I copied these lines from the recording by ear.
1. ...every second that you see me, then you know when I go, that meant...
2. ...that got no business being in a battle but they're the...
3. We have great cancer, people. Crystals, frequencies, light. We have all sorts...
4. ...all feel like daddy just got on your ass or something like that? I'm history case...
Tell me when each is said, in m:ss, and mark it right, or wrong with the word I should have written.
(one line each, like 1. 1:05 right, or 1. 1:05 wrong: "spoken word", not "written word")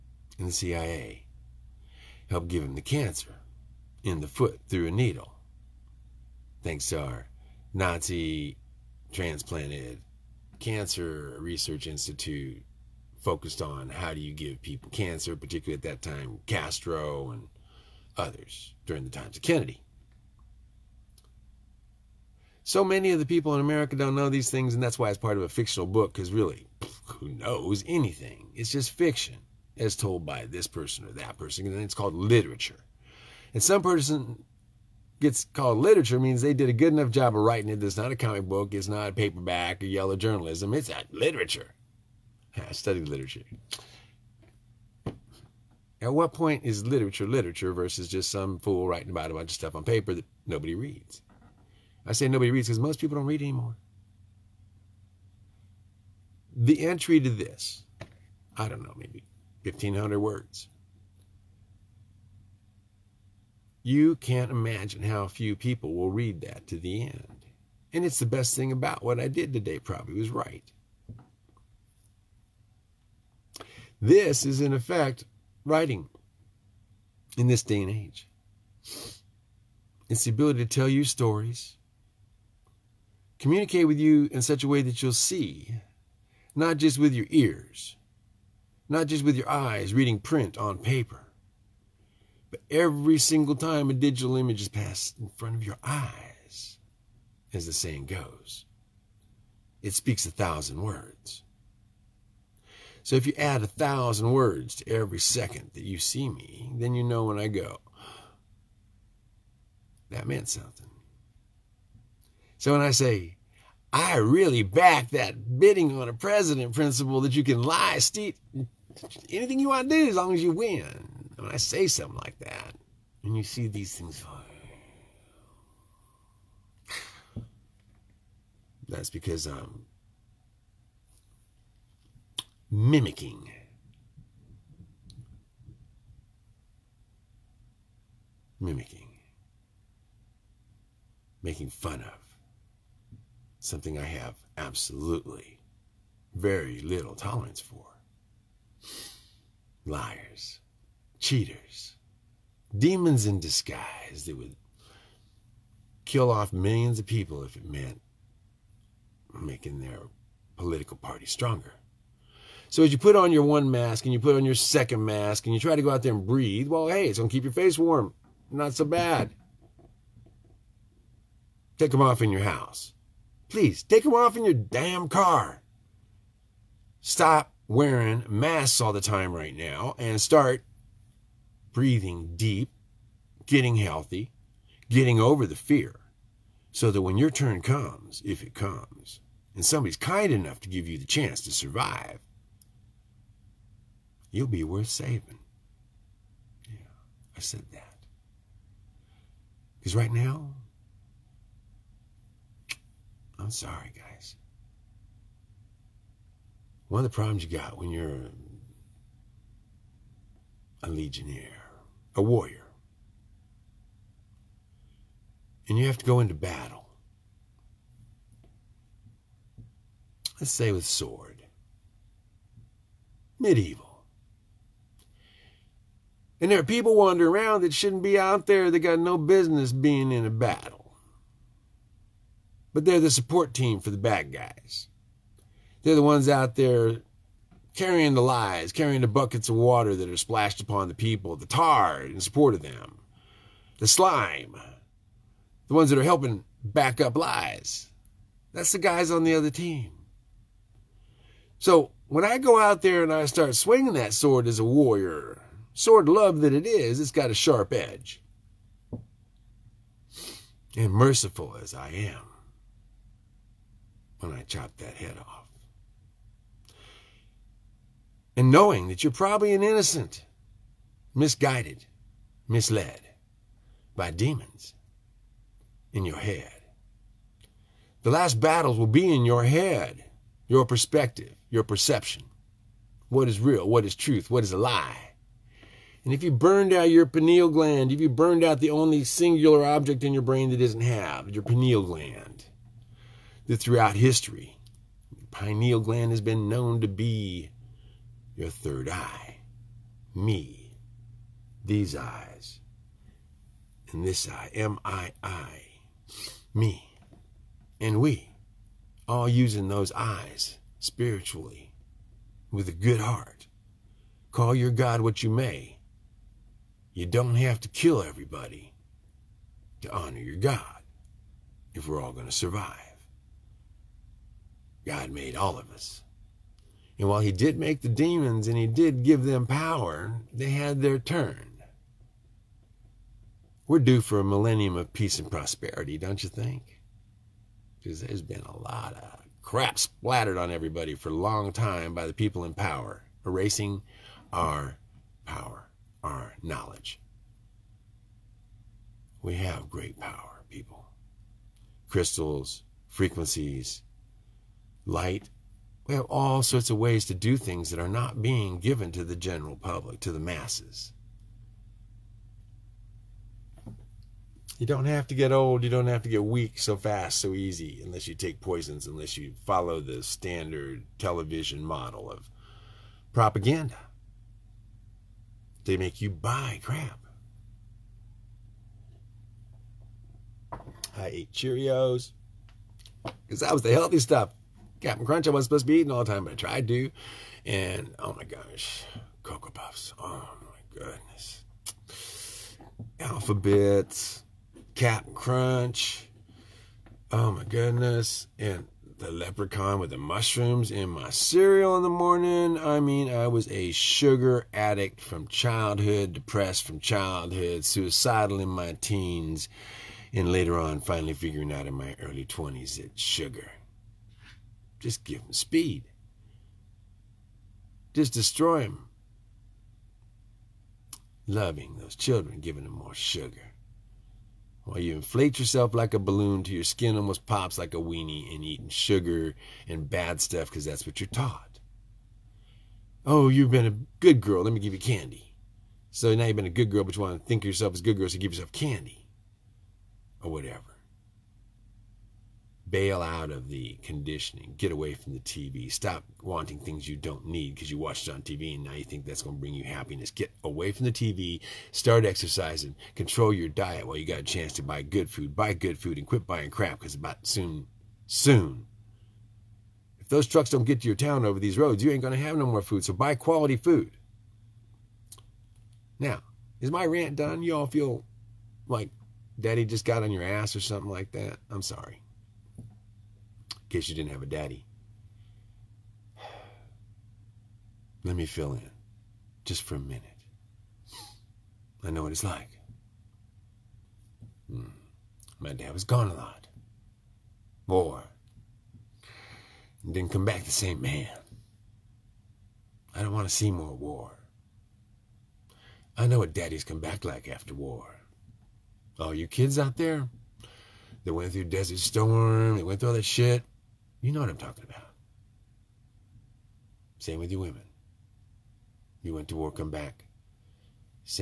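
1. 1:44 right
2. 3:48 right
3. 5:49 wrong: "power", not "cancer"
4. 7:47 wrong: "sorry", not "history".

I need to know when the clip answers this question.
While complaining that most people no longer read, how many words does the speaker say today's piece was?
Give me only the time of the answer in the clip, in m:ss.
0:59.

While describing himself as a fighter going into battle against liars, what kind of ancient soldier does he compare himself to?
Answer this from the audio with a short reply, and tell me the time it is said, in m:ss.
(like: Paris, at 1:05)
legionnaire, at 3:30.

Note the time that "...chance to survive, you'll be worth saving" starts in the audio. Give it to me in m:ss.
3:11.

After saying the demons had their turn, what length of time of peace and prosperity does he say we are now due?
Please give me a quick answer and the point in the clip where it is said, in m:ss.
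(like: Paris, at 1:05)
millennium, at 5:34.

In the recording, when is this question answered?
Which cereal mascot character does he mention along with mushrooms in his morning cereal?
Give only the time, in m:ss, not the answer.
6:39.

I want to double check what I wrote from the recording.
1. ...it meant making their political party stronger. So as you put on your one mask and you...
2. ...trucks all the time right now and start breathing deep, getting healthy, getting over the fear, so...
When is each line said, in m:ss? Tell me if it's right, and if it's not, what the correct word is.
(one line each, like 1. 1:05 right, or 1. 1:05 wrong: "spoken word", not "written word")
1. 2:37 right
2. 2:58 wrong: "masks", not "trucks".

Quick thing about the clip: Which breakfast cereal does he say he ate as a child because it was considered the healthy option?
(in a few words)
Cheerios.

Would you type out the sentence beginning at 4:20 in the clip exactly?
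And merciful as I am, when I chopped that head off.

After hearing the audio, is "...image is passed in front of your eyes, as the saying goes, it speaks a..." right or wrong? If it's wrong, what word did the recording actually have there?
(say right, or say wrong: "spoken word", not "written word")
right.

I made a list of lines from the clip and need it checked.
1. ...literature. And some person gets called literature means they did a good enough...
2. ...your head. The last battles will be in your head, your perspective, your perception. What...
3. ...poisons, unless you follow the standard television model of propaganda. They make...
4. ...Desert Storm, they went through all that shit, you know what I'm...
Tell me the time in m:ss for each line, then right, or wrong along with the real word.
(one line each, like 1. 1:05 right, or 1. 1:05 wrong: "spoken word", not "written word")
1. 0:32 right
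2. 4:36 right
3. 6:08 right
4. 8:21 right.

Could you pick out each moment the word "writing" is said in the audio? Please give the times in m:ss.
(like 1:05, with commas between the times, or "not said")
0:37, 0:48, 1:15.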